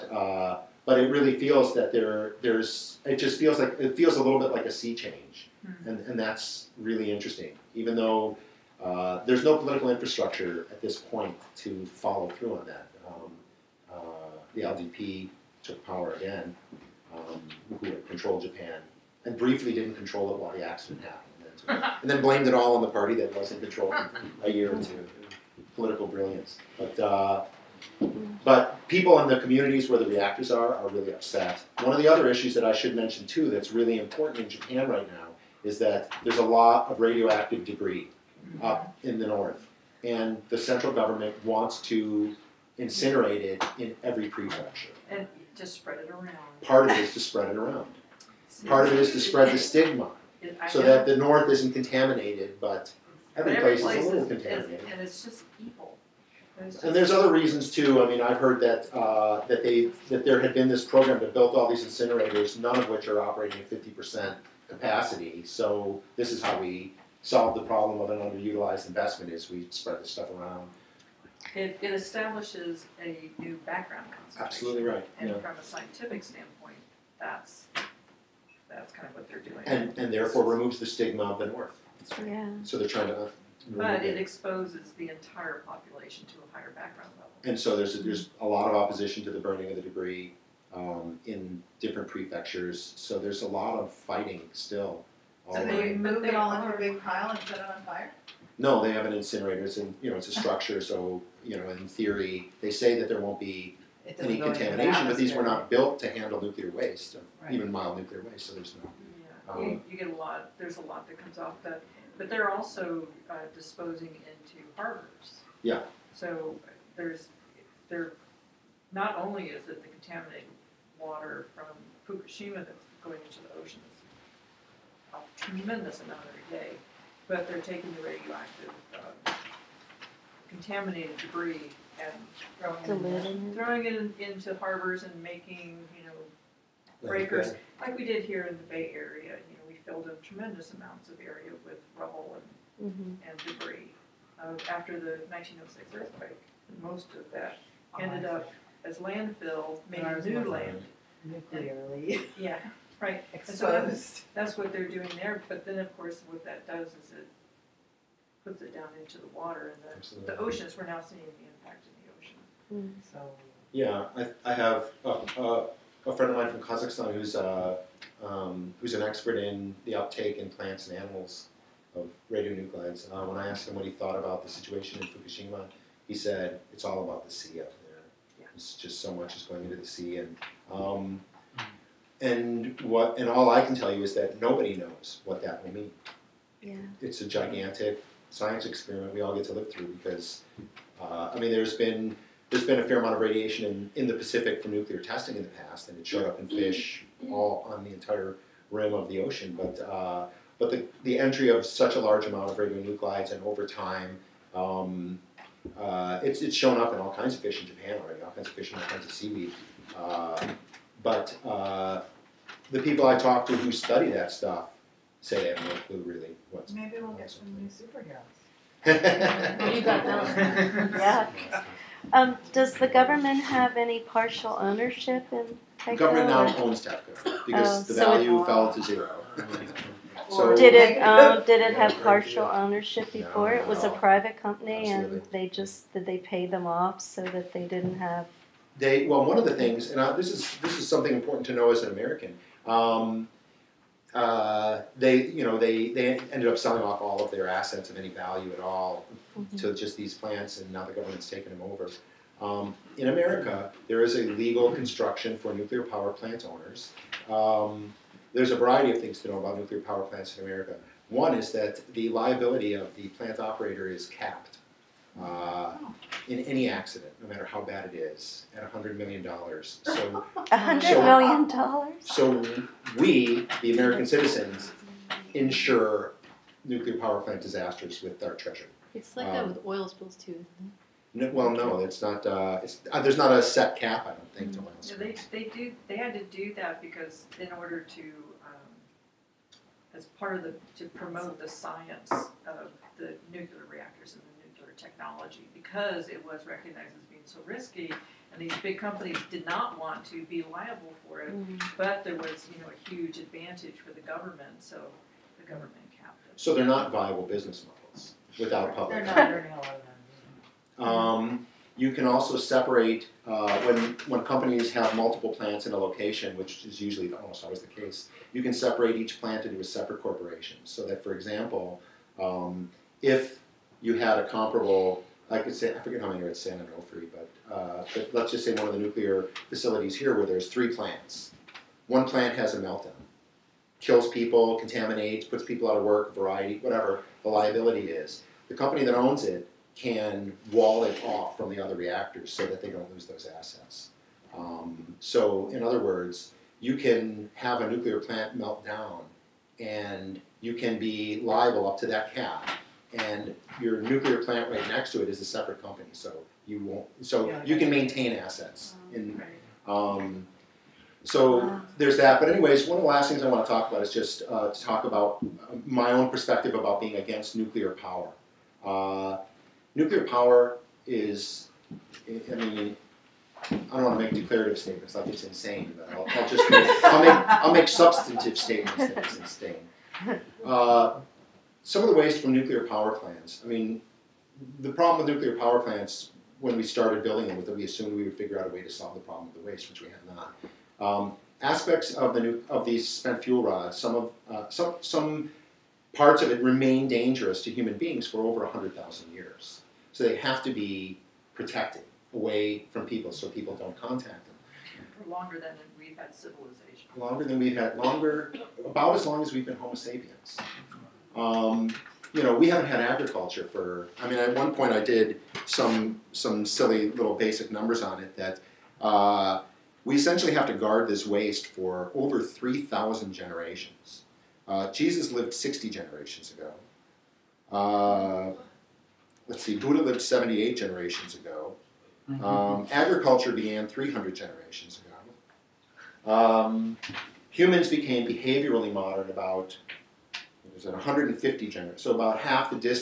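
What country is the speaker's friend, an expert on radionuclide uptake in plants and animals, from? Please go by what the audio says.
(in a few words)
Kazakhstan.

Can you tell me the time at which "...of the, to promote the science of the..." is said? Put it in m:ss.
4:50.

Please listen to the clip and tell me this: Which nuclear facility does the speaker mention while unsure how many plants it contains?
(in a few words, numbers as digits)
San Onofre.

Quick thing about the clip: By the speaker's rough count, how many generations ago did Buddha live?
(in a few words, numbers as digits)
78.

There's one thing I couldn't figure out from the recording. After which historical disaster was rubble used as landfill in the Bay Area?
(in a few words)
1906 earthquake.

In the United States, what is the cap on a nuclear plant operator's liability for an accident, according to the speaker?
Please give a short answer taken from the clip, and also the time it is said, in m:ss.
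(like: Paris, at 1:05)
$100 million, at 4:28.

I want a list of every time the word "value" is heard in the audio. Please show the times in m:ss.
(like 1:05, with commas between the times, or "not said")
3:48, 4:08.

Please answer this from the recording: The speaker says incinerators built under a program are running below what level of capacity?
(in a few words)
50%.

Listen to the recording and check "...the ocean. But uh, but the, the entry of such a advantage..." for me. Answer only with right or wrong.
wrong.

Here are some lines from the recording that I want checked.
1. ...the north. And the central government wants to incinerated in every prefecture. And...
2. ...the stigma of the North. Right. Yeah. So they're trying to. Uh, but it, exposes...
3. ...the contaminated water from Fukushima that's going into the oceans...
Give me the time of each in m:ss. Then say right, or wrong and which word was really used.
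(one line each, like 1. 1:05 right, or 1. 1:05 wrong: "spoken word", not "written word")
1. 0:39 right
2. 1:20 right
3. 1:59 right.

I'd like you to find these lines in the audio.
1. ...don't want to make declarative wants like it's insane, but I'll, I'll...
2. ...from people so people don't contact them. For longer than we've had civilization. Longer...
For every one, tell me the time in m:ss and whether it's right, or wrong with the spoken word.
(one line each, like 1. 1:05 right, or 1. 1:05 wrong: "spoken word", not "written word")
1. 6:13 wrong: "statements", not "wants"
2. 6:42 right.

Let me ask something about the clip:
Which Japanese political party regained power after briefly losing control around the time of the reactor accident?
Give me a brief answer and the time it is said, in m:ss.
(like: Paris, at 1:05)
LDP, at 0:14.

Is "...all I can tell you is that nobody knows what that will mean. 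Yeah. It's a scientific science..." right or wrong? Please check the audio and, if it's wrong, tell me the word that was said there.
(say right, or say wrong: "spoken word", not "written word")
wrong: "gigantic", not "scientific".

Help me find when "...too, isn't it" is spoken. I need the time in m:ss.
4:40.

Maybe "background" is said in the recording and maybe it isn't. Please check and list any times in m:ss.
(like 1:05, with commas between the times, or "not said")
1:13, 1:26.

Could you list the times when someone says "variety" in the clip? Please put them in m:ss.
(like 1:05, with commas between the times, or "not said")
4:18, 5:36.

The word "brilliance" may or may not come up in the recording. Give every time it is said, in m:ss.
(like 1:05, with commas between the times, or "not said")
0:26.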